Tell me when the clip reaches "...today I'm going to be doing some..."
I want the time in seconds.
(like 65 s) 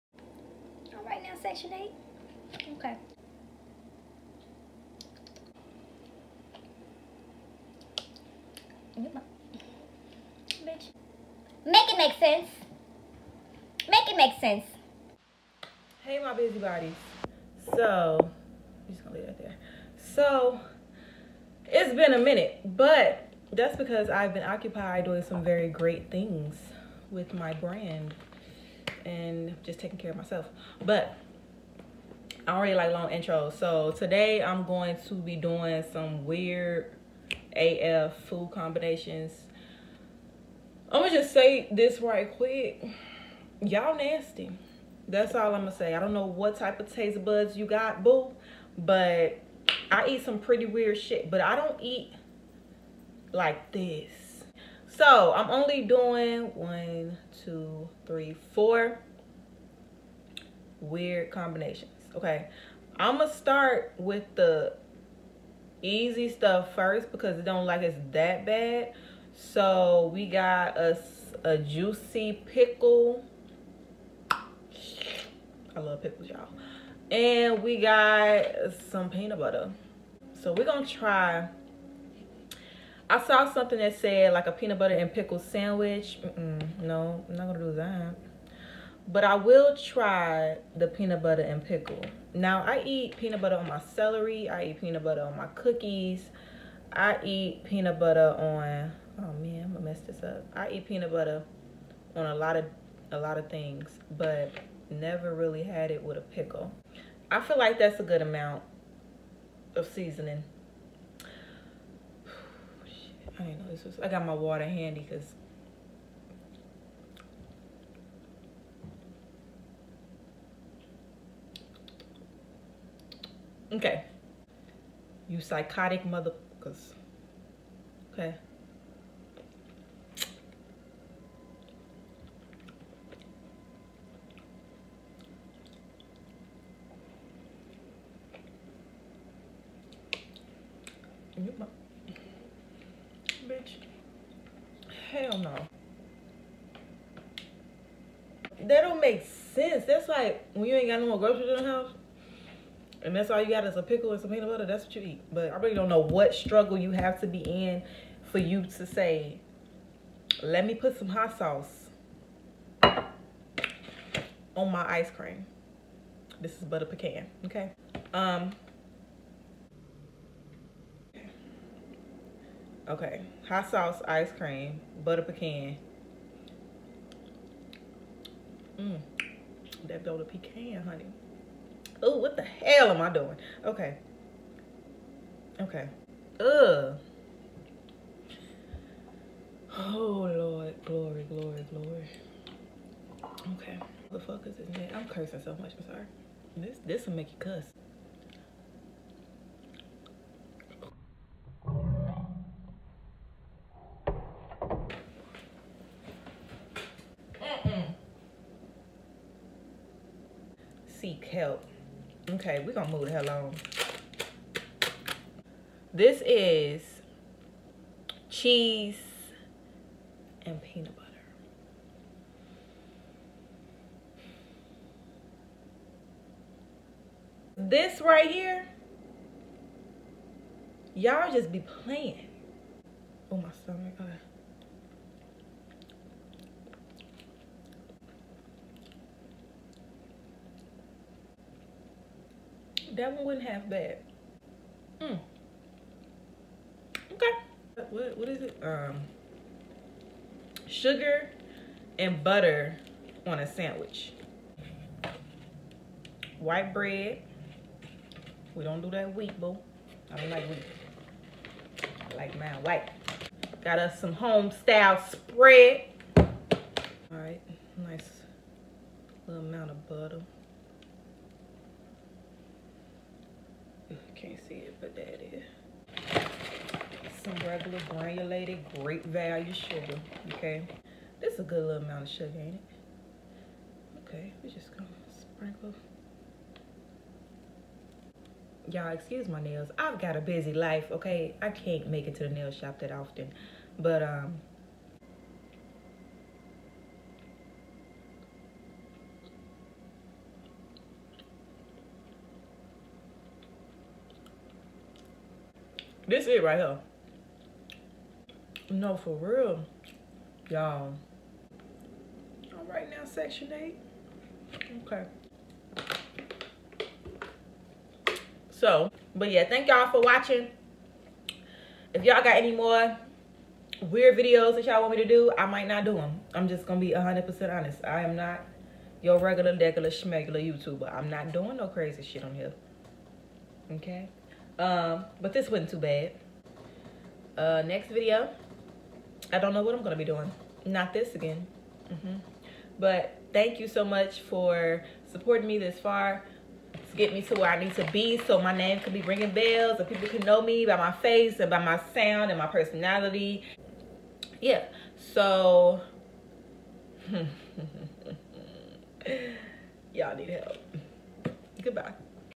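33 s.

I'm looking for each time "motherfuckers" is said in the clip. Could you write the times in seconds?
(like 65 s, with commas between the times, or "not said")
126 s.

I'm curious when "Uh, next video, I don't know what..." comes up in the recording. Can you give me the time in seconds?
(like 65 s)
337 s.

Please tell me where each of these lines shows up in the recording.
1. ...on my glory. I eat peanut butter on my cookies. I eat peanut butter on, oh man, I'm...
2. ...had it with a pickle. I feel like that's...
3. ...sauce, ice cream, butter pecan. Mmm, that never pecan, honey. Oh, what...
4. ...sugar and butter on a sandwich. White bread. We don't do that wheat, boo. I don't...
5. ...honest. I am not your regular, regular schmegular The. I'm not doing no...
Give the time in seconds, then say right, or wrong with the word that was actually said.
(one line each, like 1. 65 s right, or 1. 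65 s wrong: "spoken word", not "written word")
1. 93 s wrong: "celery", not "glory"
2. 105 s right
3. 173 s wrong: "butter", not "never"
4. 250 s right
5. 327 s wrong: "YouTuber", not "The".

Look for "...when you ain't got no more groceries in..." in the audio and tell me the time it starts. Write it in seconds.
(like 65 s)
150 s.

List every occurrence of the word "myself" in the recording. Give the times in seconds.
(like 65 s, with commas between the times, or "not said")
30 s.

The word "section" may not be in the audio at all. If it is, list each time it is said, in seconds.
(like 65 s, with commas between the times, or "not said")
1 s, 313 s.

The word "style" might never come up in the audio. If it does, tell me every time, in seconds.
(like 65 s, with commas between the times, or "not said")
264 s.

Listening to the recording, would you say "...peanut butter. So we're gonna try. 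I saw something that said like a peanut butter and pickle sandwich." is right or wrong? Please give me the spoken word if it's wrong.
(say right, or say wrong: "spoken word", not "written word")
right.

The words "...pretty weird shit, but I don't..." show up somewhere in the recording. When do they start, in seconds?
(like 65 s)
50 s.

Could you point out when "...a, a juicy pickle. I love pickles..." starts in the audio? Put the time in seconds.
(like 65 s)
71 s.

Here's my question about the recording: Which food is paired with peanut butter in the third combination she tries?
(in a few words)
Cheese.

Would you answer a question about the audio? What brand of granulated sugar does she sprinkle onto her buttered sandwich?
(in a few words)
Great Value.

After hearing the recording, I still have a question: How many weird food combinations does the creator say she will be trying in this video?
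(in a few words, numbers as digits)
4.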